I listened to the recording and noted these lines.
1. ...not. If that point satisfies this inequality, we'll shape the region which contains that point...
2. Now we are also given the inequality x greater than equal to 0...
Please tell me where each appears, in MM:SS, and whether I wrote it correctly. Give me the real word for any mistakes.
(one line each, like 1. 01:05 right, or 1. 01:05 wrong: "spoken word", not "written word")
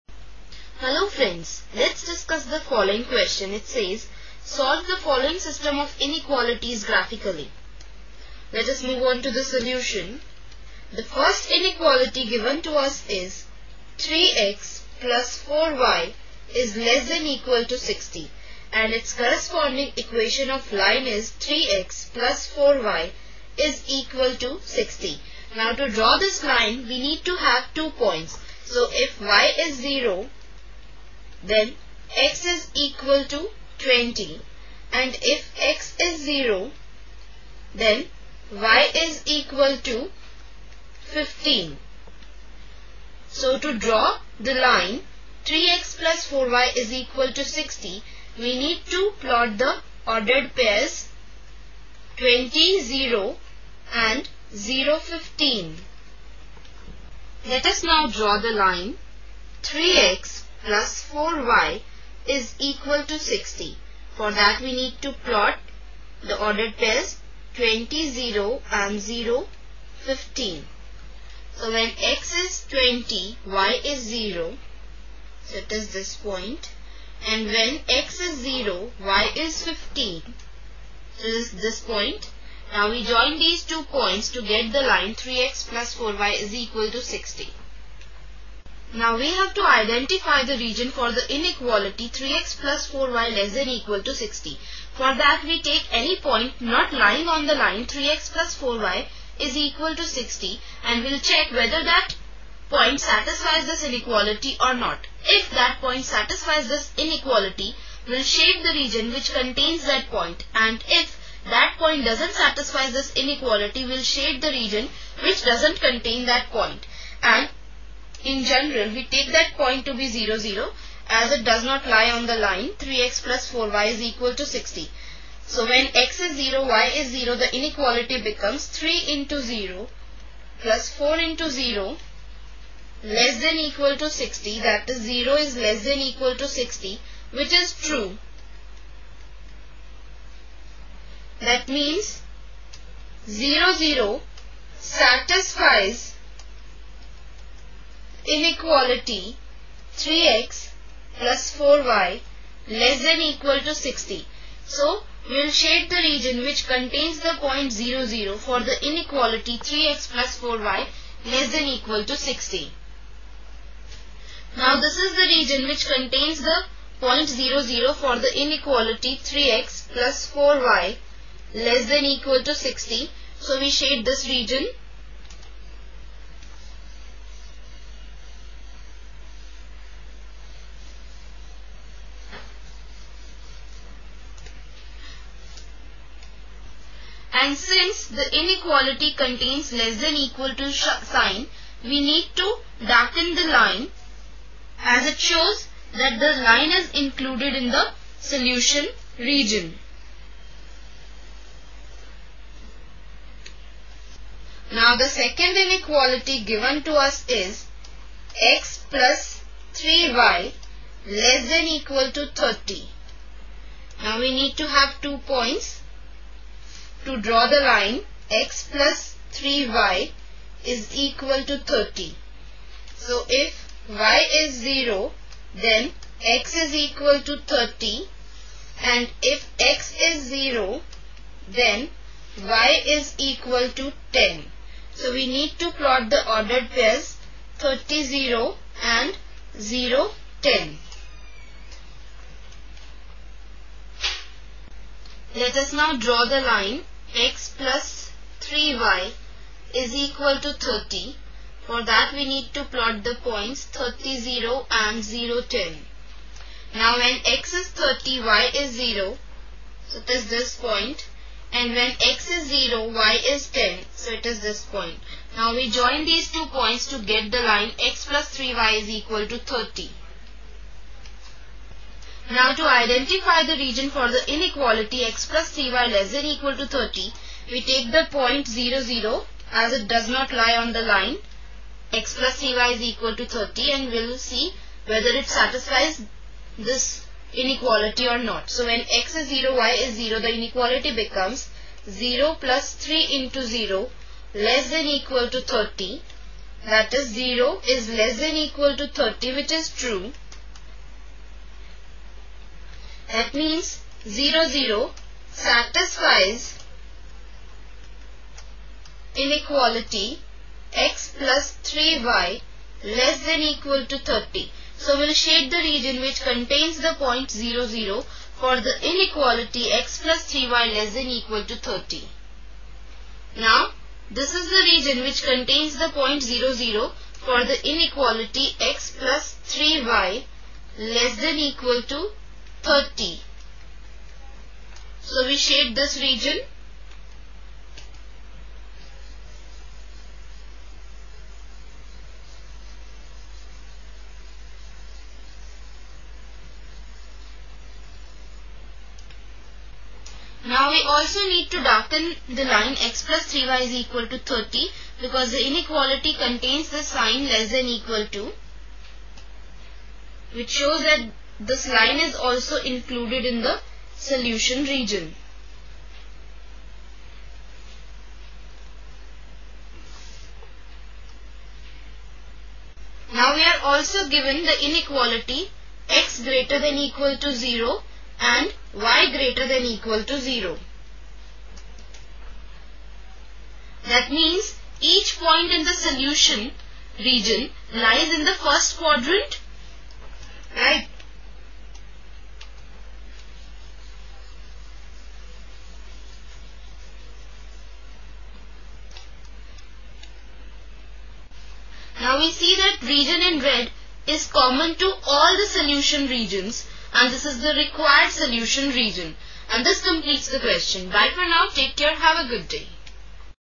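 1. 01:44 right
2. 06:13 right.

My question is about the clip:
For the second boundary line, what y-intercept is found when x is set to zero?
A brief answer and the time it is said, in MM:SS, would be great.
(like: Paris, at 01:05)
10, at 03:52.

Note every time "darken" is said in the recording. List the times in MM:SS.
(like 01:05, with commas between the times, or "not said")
03:12, 05:51.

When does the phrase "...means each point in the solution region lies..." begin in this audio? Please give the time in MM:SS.
06:24.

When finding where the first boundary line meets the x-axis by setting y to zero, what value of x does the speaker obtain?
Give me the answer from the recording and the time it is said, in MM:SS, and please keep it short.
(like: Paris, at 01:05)
20, at 00:32.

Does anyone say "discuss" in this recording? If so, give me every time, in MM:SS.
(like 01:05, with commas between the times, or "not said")
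00:02.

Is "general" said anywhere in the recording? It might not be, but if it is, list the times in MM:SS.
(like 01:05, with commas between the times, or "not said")
01:58.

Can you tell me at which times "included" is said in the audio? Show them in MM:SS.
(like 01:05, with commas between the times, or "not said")
03:16, 06:02.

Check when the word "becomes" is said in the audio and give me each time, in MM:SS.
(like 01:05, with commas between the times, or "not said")
02:08, 04:50.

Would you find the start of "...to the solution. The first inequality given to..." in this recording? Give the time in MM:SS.
00:09.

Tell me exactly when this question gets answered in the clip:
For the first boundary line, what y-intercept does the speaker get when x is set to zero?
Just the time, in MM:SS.
00:38.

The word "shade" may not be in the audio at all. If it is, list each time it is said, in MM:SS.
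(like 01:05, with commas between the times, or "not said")
01:54, 02:35, 02:53, 05:15, 05:35.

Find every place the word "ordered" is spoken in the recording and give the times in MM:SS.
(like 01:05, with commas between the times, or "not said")
00:50, 01:06, 03:56.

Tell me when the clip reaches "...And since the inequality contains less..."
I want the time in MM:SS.
03:07.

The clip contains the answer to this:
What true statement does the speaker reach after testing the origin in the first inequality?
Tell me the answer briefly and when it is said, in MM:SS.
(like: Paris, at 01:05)
0 is less than equal to 60, at 02:15.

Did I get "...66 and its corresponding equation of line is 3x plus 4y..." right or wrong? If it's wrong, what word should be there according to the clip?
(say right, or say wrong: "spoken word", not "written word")
wrong: "60", not "66".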